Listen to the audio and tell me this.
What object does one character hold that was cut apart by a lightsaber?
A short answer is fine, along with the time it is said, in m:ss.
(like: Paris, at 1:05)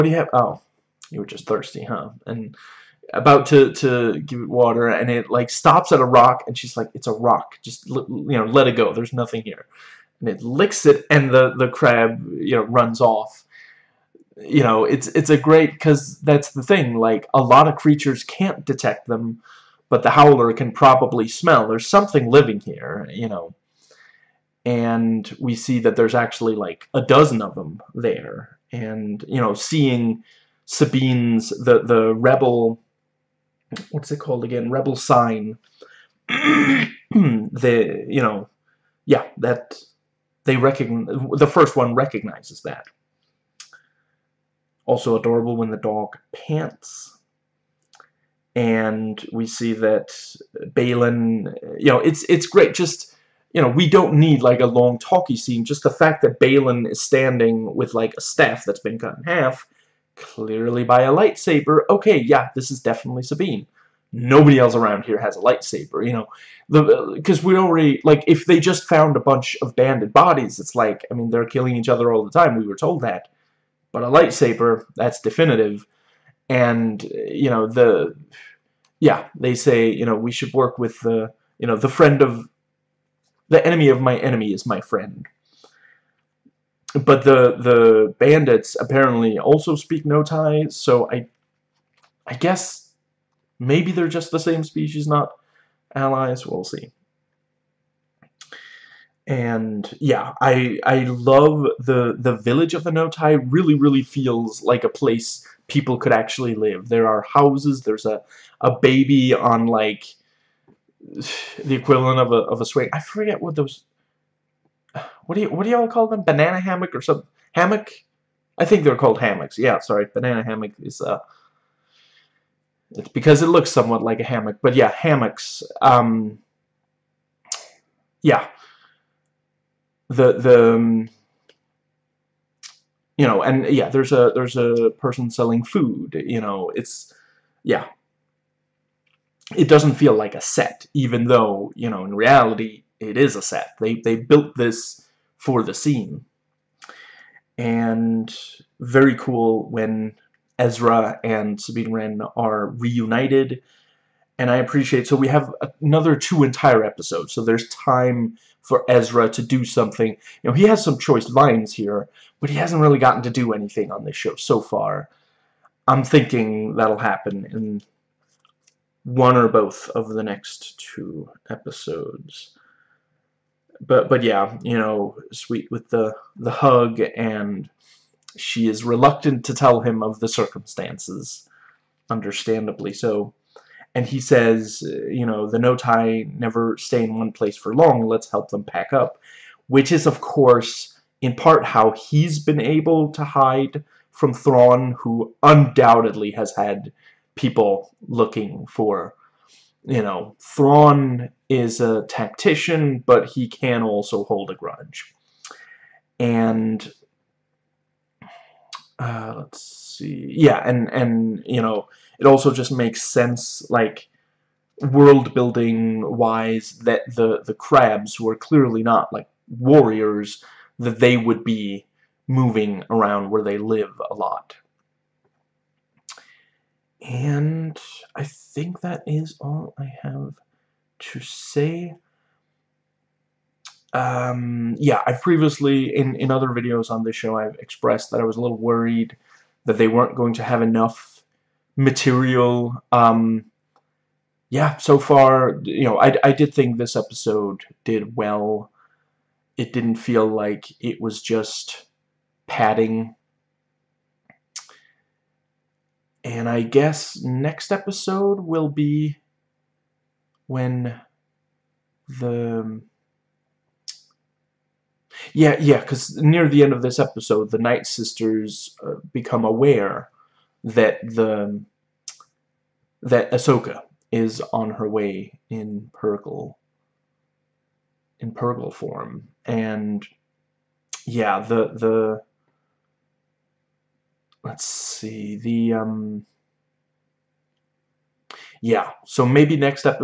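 a staff, at 0:58.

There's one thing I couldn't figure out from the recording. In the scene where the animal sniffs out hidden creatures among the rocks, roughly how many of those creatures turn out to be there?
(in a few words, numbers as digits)
a dozen.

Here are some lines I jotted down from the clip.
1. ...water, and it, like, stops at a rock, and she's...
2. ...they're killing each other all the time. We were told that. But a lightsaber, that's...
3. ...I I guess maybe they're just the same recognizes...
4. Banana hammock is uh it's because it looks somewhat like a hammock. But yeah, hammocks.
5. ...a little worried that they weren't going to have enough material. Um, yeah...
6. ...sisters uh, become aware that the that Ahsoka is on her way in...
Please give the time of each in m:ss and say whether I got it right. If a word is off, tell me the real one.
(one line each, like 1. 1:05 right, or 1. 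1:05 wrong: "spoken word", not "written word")
1. 0:04 right
2. 1:11 right
3. 1:31 wrong: "species", not "recognizes"
4. 2:00 right
5. 3:58 right
6. 4:27 right.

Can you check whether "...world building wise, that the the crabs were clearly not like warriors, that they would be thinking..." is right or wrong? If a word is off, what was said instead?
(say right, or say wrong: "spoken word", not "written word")
wrong: "moving", not "thinking".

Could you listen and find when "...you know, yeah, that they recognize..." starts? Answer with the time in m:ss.
0:38.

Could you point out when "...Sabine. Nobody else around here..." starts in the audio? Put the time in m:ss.
1:03.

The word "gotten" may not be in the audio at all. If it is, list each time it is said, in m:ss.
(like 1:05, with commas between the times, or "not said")
2:42.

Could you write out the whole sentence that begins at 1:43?
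Really, really feels like a place people could actually live.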